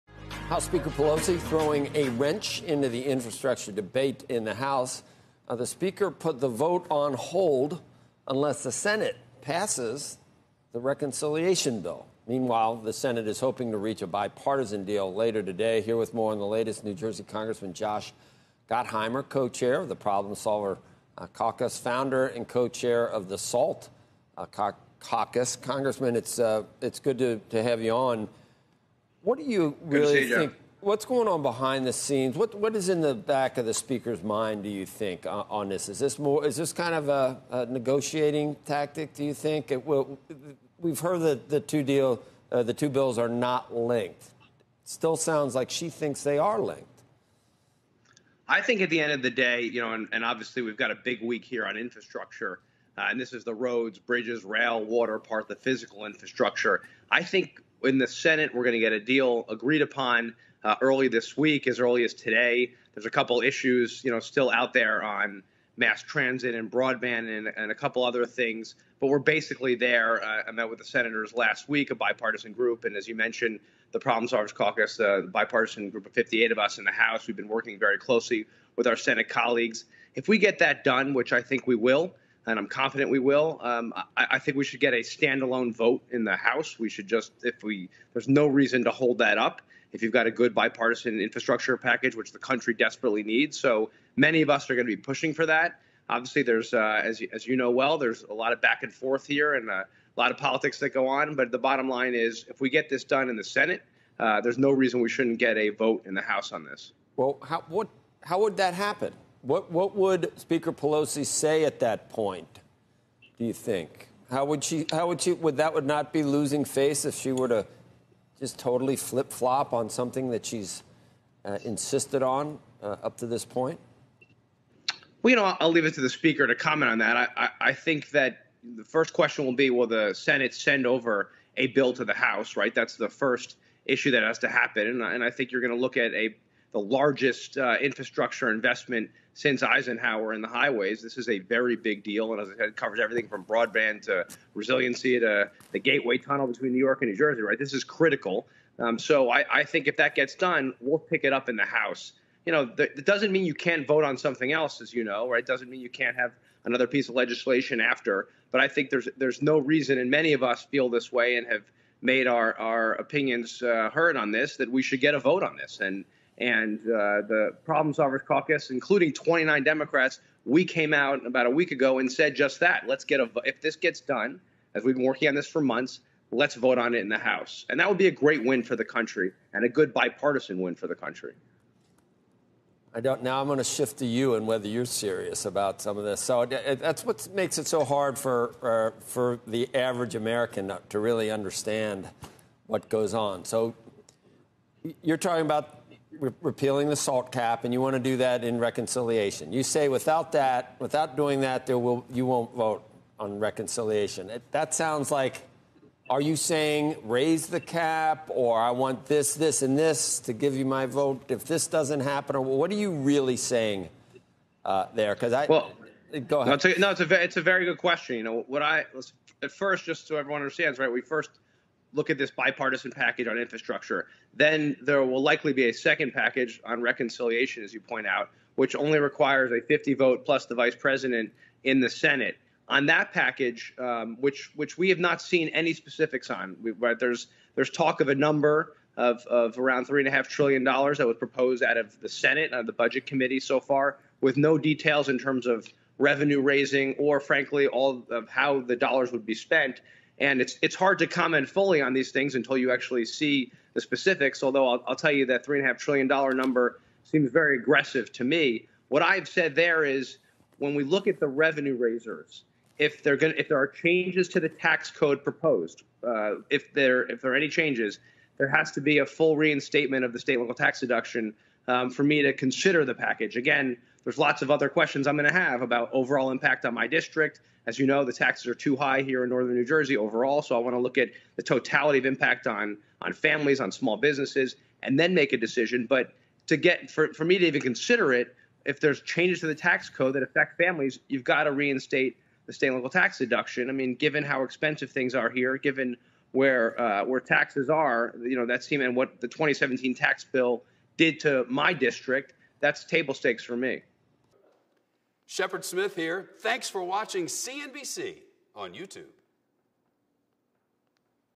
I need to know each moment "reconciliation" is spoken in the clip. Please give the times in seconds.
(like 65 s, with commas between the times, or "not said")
10 s, 198 s, 203 s, 226 s.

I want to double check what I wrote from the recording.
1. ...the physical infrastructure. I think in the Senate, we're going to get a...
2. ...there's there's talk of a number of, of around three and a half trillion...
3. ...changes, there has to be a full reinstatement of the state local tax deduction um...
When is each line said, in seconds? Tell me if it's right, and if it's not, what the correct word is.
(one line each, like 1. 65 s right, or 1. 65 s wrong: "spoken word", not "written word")
1. 55 s right
2. 236 s right
3. 267 s right.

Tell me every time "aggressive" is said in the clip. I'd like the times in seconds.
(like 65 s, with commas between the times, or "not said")
257 s.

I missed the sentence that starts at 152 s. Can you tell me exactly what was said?
You know, th- it doesn't mean you can't vote on something else, as you know, right?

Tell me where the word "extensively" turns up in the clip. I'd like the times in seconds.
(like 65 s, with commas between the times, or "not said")
not said.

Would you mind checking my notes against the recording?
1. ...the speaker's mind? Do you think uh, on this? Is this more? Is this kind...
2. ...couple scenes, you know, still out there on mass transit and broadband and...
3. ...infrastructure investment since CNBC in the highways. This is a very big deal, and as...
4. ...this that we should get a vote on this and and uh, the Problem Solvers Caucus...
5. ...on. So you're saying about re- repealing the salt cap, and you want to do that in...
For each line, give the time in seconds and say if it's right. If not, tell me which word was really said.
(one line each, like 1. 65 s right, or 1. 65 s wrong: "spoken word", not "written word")
1. 33 s right
2. 63 s wrong: "issues", not "scenes"
3. 137 s wrong: "Eisenhower", not "CNBC"
4. 164 s right
5. 193 s wrong: "talking", not "saying".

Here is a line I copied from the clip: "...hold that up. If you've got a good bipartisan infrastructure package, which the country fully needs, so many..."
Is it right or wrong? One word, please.
wrong.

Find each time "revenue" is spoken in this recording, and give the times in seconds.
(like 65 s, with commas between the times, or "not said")
245 s, 261 s.